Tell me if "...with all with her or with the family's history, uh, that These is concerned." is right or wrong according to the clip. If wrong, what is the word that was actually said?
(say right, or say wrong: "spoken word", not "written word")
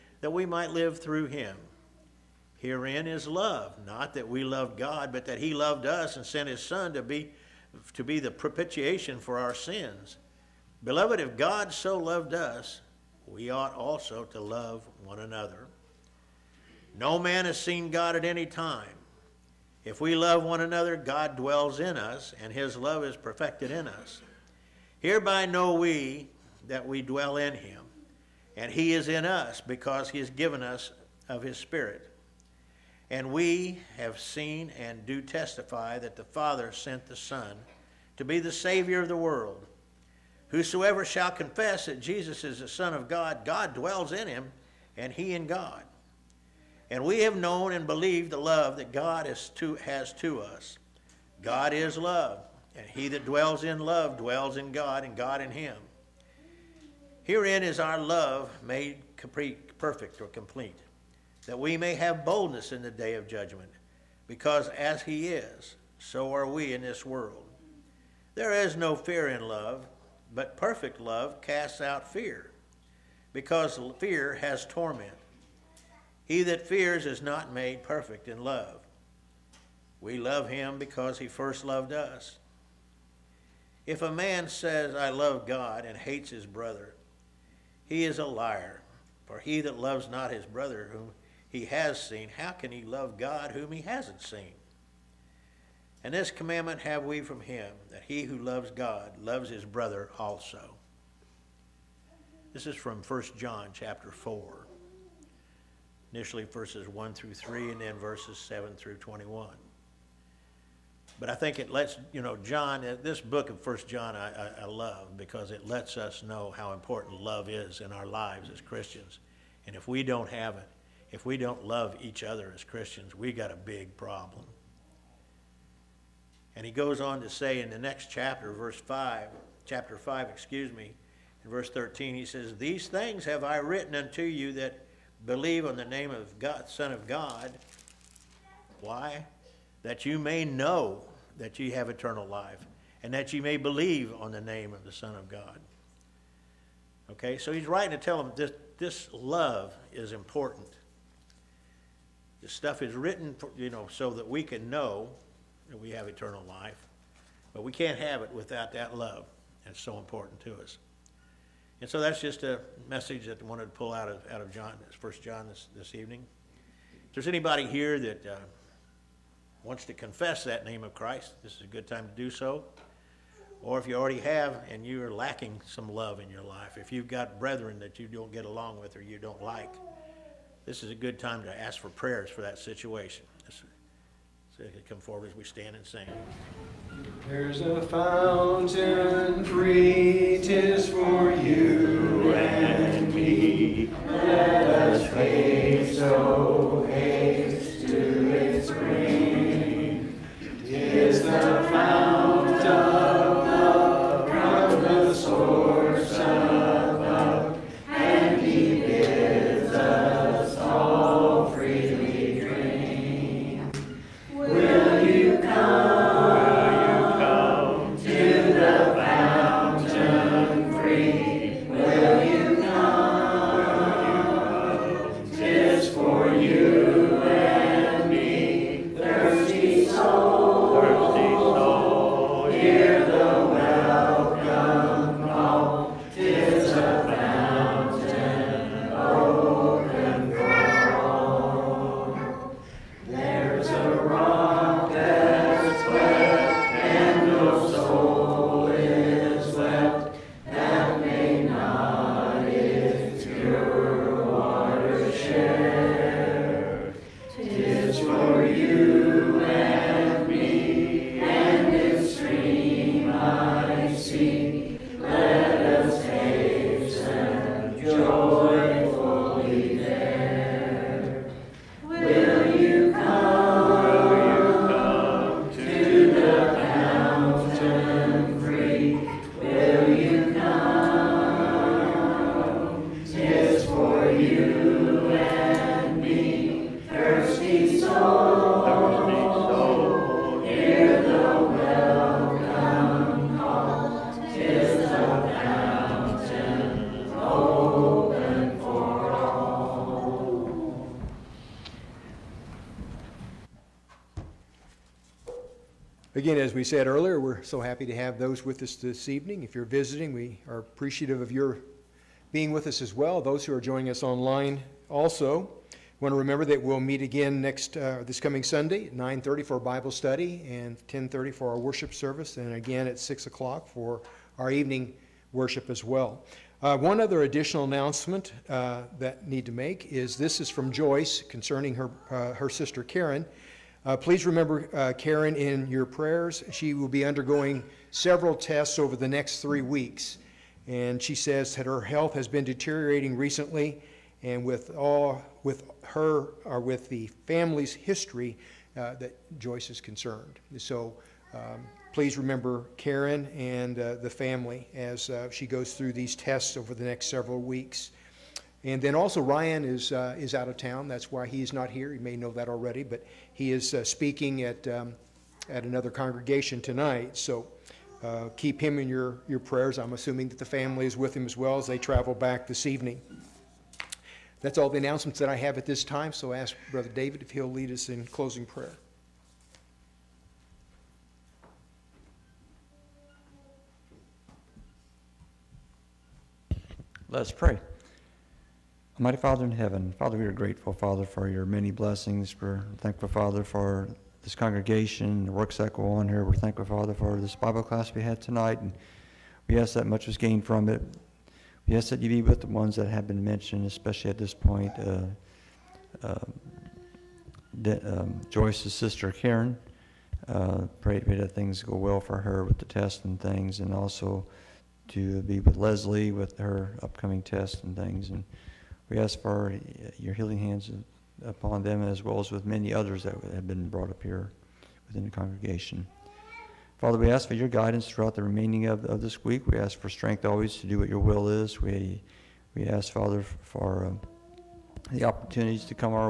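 wrong: "Joyce", not "These".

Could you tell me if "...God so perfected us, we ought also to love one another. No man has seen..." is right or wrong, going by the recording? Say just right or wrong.
wrong.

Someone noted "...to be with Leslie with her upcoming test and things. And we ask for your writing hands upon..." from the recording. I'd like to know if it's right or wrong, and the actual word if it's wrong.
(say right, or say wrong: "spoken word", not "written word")
wrong: "healing", not "writing".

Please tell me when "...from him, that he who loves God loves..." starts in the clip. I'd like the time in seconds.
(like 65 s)
97 s.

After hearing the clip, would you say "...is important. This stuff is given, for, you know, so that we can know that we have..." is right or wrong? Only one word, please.
wrong.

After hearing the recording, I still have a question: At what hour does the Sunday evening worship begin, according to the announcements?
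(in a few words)
6 o'clock.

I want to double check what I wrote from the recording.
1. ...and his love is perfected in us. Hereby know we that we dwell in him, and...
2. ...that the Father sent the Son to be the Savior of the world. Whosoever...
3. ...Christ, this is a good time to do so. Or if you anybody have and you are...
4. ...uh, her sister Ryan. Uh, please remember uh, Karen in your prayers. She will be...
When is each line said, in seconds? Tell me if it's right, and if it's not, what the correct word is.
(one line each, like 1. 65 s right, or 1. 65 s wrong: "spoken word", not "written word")
1. 22 s right
2. 35 s right
3. 170 s wrong: "already", not "anybody"
4. 332 s wrong: "Karen", not "Ryan".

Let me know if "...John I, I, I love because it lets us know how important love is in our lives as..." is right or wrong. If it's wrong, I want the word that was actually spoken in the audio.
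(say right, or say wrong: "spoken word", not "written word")
right.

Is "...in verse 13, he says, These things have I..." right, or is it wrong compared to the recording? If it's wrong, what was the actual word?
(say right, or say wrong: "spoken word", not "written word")
right.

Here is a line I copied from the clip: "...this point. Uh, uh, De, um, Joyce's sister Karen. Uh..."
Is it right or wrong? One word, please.
right.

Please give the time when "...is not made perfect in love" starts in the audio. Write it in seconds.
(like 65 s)
77 s.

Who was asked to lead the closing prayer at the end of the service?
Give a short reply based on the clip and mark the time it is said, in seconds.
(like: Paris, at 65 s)
Brother David, at 376 s.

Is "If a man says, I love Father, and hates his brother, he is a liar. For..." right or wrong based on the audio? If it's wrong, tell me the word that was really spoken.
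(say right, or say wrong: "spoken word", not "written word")
wrong: "God", not "Father".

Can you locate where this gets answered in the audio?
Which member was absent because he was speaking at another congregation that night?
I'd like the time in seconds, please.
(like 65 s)
359 s.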